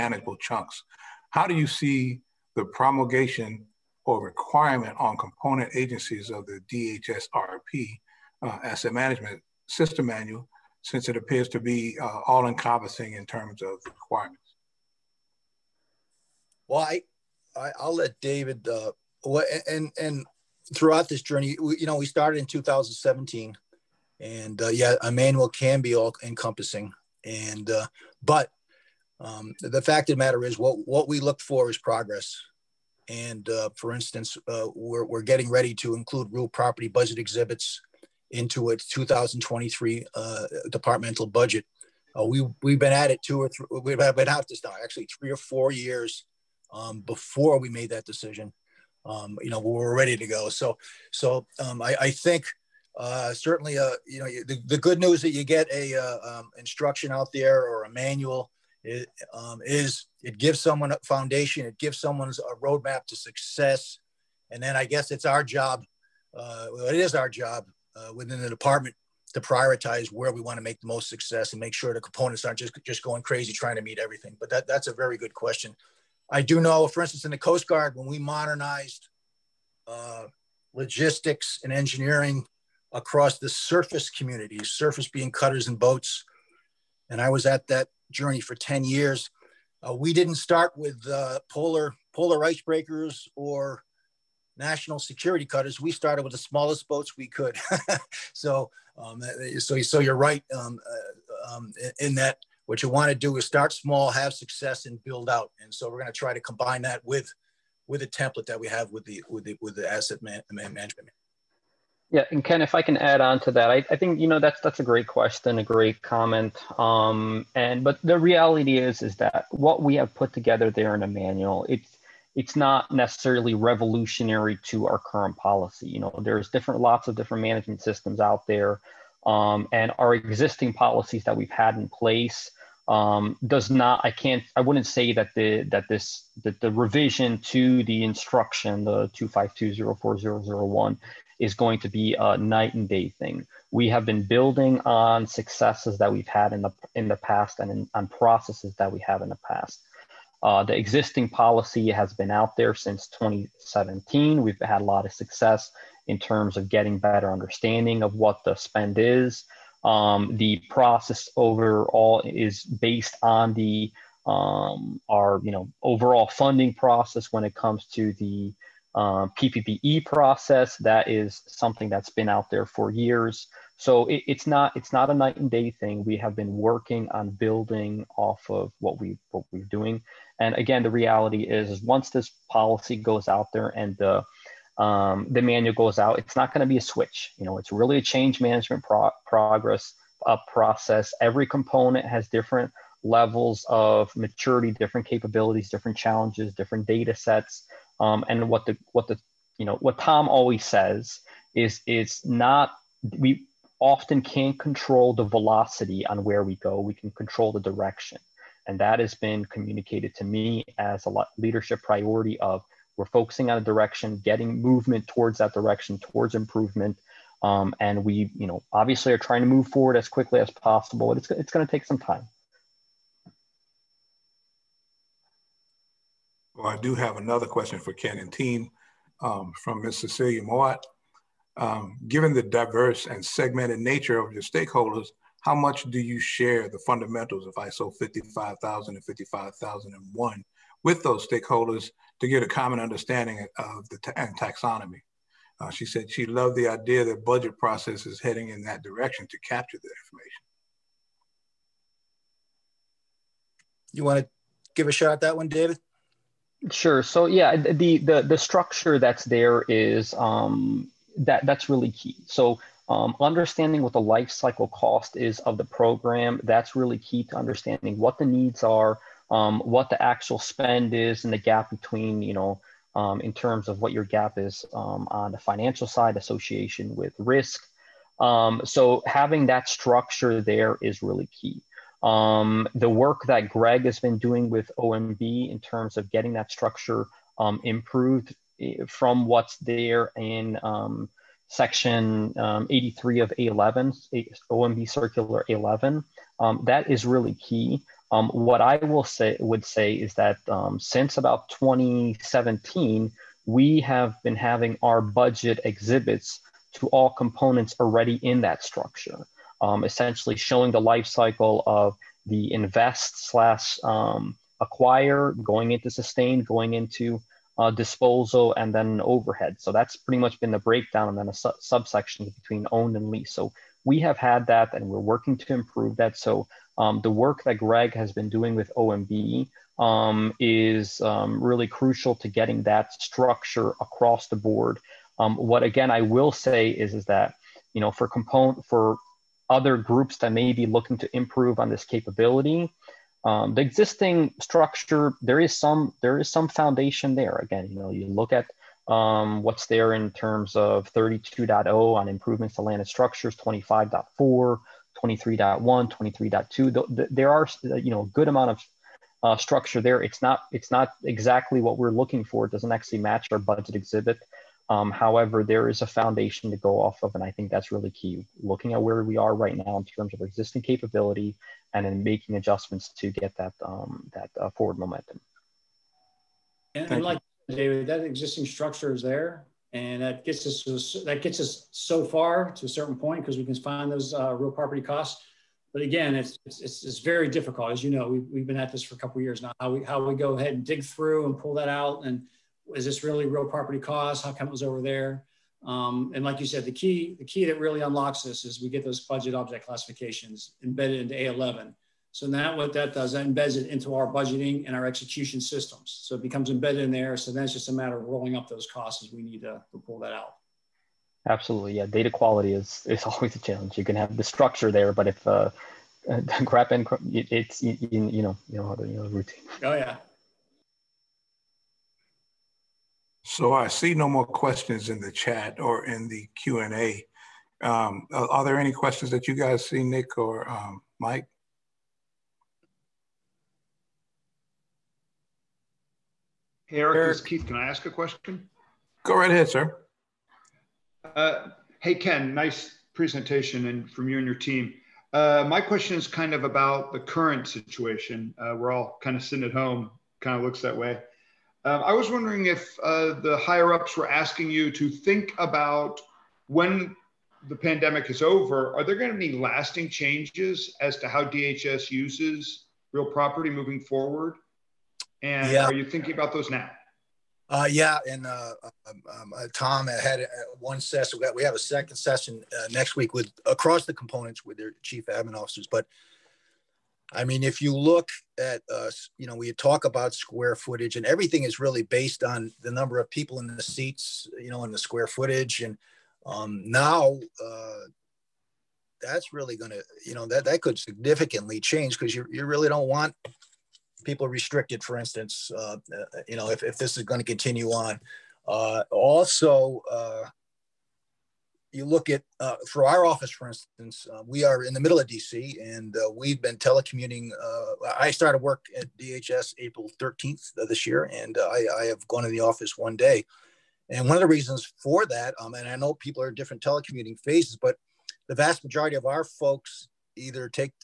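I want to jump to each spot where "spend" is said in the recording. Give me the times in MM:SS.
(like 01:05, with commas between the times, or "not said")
02:38, 04:30.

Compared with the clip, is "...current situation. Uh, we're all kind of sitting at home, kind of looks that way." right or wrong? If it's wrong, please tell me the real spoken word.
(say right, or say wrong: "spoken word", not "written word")
right.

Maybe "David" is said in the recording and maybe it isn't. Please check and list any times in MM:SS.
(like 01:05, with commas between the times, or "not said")
00:18, 04:15, 06:17.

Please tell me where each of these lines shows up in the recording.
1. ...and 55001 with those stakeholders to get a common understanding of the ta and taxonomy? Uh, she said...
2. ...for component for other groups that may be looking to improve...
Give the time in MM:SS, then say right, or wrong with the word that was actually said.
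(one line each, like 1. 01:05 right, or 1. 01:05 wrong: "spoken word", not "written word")
1. 03:58 right
2. 05:37 right.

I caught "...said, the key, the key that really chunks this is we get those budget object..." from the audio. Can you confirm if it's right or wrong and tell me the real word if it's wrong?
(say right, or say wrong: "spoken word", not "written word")
wrong: "unlocks", not "chunks".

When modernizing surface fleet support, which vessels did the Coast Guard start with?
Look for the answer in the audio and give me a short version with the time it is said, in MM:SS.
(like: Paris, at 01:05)
smallest boats, at 01:36.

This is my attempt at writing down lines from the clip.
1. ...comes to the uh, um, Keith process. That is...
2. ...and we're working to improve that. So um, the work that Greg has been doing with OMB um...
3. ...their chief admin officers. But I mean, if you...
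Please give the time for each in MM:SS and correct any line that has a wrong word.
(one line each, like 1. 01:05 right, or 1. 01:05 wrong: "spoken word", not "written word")
1. 02:47 wrong: "PPBE", not "Keith"
2. 05:24 right
3. 07:54 right.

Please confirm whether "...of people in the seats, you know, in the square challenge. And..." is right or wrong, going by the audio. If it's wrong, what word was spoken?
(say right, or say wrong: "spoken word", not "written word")
wrong: "footage", not "challenge".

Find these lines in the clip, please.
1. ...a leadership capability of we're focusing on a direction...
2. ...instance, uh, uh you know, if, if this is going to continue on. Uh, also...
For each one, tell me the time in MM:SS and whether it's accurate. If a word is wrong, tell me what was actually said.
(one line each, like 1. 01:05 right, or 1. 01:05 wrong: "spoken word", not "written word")
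1. 03:31 wrong: "priority", not "capability"
2. 08:14 right.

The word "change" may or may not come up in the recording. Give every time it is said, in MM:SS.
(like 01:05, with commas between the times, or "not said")
03:08, 07:39, 08:11.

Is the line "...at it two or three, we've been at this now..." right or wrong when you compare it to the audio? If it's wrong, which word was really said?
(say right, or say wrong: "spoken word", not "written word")
right.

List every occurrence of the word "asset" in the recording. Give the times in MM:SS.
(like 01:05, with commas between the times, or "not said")
00:08, 01:49.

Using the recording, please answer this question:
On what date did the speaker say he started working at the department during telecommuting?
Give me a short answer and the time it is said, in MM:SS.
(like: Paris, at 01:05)
April 13, at 08:29.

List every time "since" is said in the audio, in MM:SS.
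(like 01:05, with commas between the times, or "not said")
00:10, 02:32, 05:00.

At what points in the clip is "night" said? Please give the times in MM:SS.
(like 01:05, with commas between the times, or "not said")
02:22, 02:55.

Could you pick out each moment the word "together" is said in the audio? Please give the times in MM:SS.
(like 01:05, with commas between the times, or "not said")
02:00.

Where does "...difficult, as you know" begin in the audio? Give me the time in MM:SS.
06:27.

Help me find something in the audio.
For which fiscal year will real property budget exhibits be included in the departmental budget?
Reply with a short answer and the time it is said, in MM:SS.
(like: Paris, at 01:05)
2023, at 00:38.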